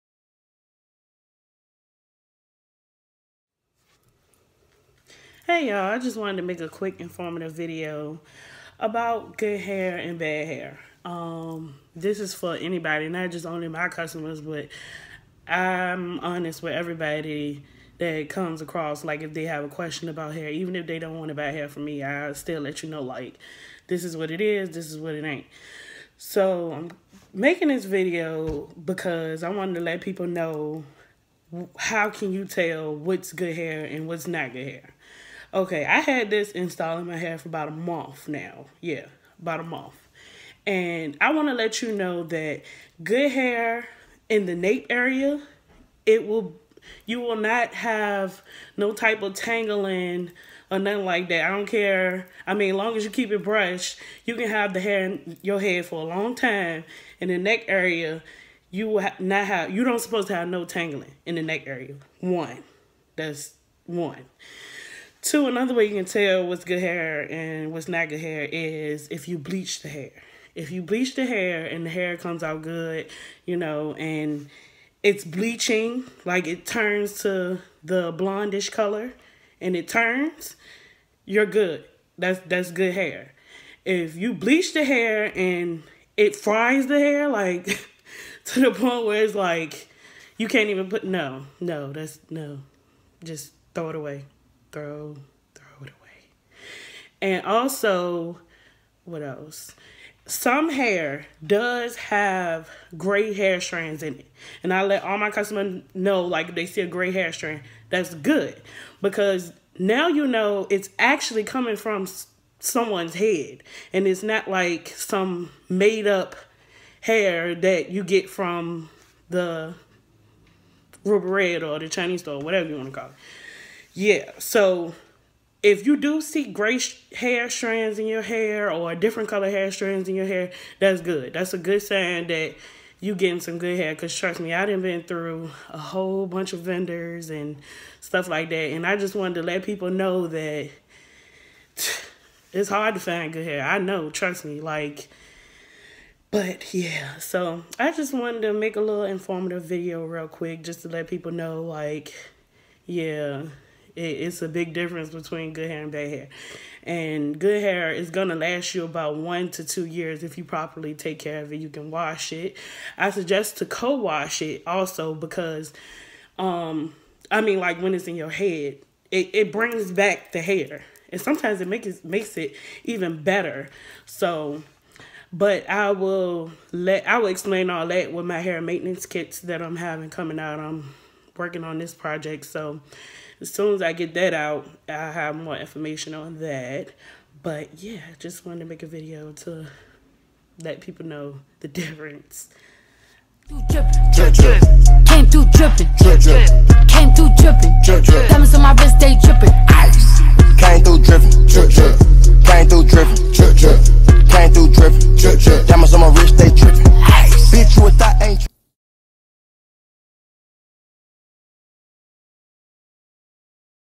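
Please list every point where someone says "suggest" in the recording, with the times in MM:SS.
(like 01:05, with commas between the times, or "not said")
02:43.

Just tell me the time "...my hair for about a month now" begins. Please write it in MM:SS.
00:37.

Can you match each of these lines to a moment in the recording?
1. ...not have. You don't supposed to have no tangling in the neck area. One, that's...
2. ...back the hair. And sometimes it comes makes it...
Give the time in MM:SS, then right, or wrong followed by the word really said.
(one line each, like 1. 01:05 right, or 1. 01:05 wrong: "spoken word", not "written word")
1. 00:59 right
2. 02:49 wrong: "makes", not "comes".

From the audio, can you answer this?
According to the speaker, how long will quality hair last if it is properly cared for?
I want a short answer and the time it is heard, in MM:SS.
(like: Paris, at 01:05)
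1 to 2 years, at 02:39.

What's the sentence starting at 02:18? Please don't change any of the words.
And I just wanted to let people know that it's hard to find good hair.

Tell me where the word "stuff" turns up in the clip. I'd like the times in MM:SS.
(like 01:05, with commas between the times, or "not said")
02:17.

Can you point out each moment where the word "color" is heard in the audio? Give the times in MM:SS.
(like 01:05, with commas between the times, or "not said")
01:18, 02:09.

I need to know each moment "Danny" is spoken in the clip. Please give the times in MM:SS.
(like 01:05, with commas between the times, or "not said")
not said.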